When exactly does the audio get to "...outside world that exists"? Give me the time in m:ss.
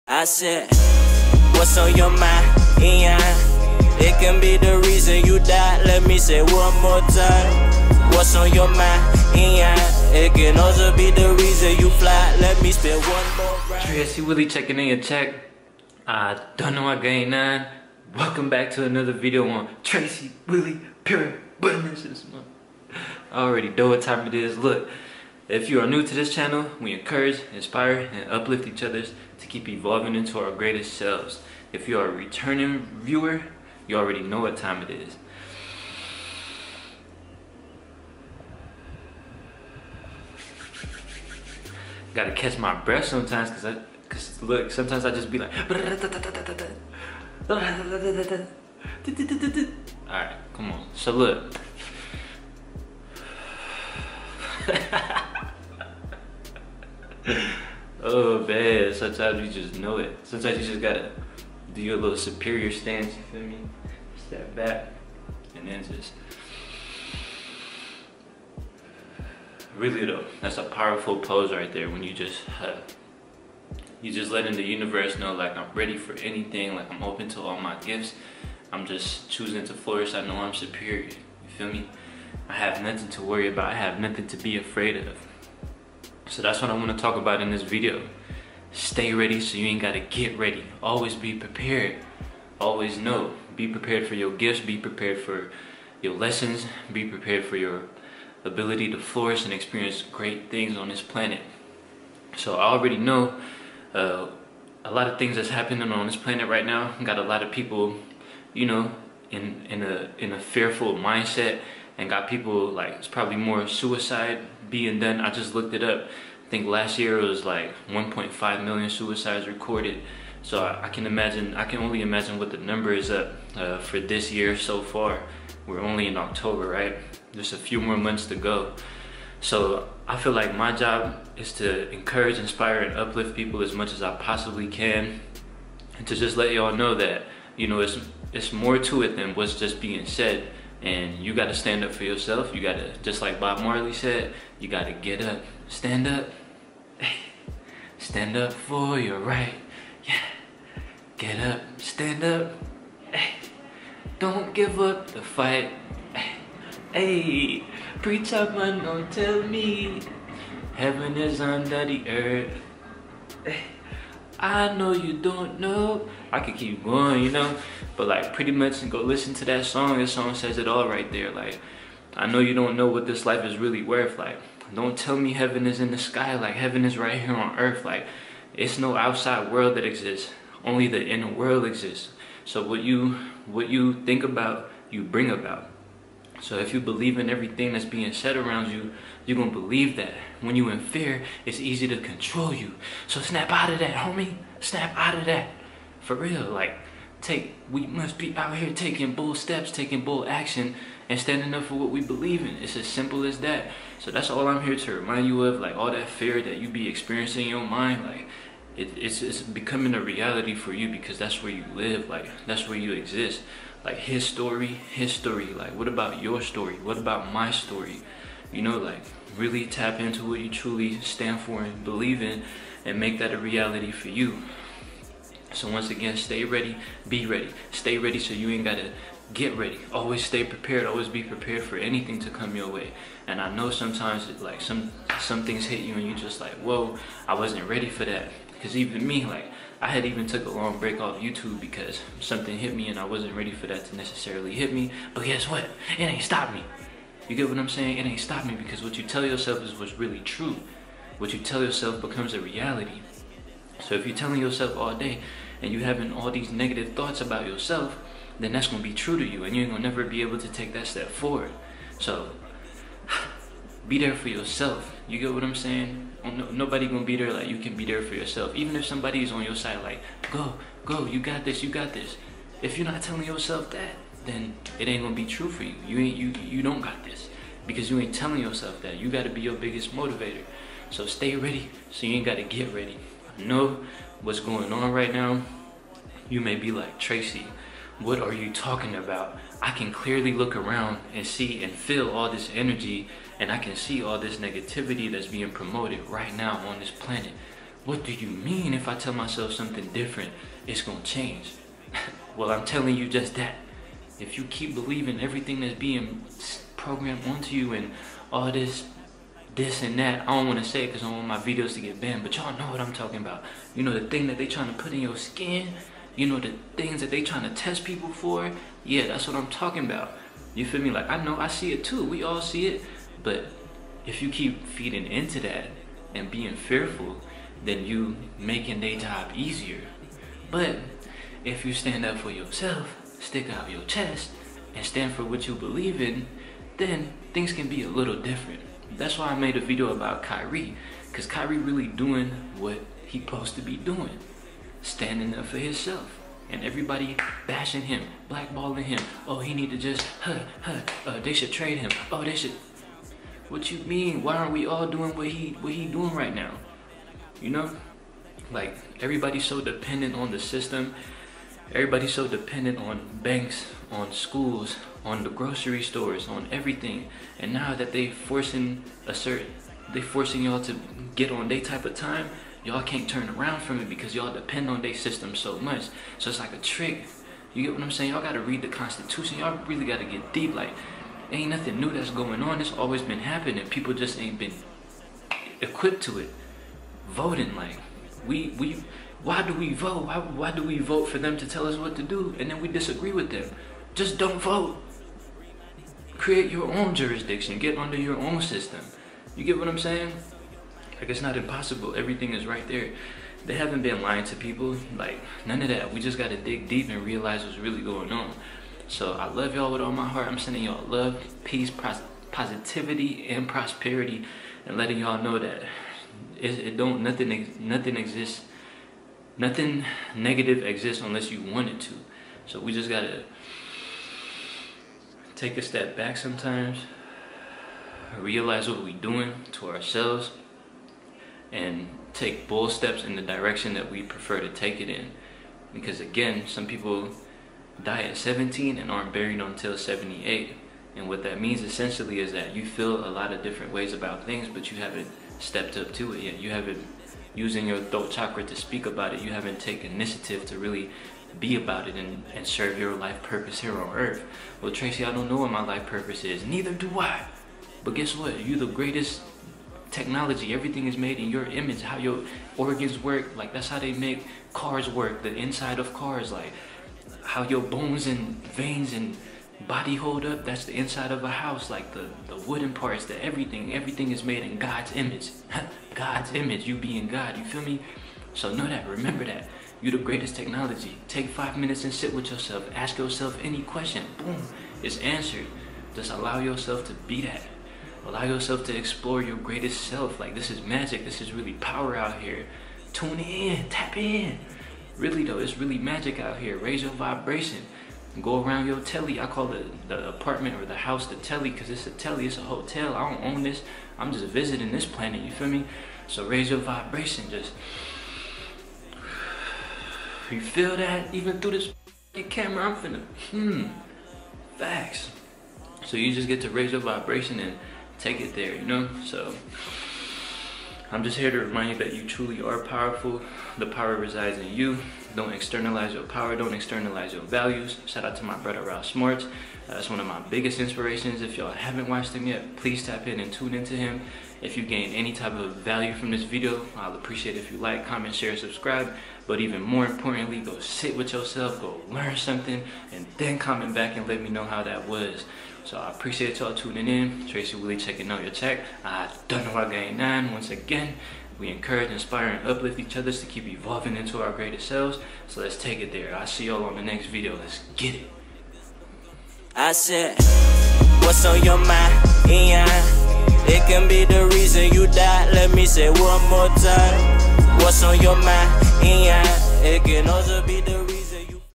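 2:58.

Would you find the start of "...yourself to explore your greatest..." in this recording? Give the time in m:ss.
8:08.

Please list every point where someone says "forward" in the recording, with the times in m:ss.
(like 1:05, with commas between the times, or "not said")
4:21.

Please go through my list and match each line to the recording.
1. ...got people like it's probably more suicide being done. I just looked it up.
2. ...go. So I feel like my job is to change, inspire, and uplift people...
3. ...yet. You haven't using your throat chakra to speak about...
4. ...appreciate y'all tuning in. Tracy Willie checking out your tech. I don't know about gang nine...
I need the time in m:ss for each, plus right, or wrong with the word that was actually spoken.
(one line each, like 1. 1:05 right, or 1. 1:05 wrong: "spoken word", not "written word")
1. 1:52 right
2. 2:08 wrong: "encourage", not "change"
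3. 7:26 right
4. 9:05 right.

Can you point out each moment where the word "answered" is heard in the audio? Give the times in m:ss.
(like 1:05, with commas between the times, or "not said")
8:04.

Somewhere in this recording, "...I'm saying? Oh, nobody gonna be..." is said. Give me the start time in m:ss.
4:25.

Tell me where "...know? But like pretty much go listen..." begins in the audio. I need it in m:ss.
2:47.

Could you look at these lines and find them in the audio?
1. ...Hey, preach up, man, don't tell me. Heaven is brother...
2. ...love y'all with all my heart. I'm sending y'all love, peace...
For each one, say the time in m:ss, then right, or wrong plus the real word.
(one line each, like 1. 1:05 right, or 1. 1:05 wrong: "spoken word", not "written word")
1. 2:36 wrong: "under", not "brother"
2. 6:49 right.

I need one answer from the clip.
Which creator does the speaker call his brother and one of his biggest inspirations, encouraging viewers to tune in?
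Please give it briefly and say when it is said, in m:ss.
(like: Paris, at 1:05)
Ralph Smarts, at 8:48.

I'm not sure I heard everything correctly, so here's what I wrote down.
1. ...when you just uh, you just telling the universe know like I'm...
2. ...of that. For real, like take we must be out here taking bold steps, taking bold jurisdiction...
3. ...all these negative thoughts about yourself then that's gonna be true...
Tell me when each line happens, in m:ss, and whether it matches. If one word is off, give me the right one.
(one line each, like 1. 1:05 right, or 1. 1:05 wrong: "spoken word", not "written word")
1. 1:11 wrong: "letting", not "telling"
2. 3:15 wrong: "action", not "jurisdiction"
3. 4:16 right.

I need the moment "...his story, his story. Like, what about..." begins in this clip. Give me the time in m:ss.
3:33.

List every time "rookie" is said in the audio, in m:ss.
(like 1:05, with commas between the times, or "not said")
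not said.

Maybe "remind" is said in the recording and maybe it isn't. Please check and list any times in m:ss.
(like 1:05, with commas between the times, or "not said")
3:24, 8:41.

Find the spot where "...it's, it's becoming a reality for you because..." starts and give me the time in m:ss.
3:28.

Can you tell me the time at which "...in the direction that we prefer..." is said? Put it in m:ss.
7:13.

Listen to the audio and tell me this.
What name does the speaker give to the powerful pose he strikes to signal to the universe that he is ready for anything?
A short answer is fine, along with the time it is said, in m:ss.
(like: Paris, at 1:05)
superior stance, at 1:02.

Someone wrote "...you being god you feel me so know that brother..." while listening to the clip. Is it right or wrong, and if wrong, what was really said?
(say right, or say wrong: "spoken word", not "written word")
wrong: "remember", not "brother".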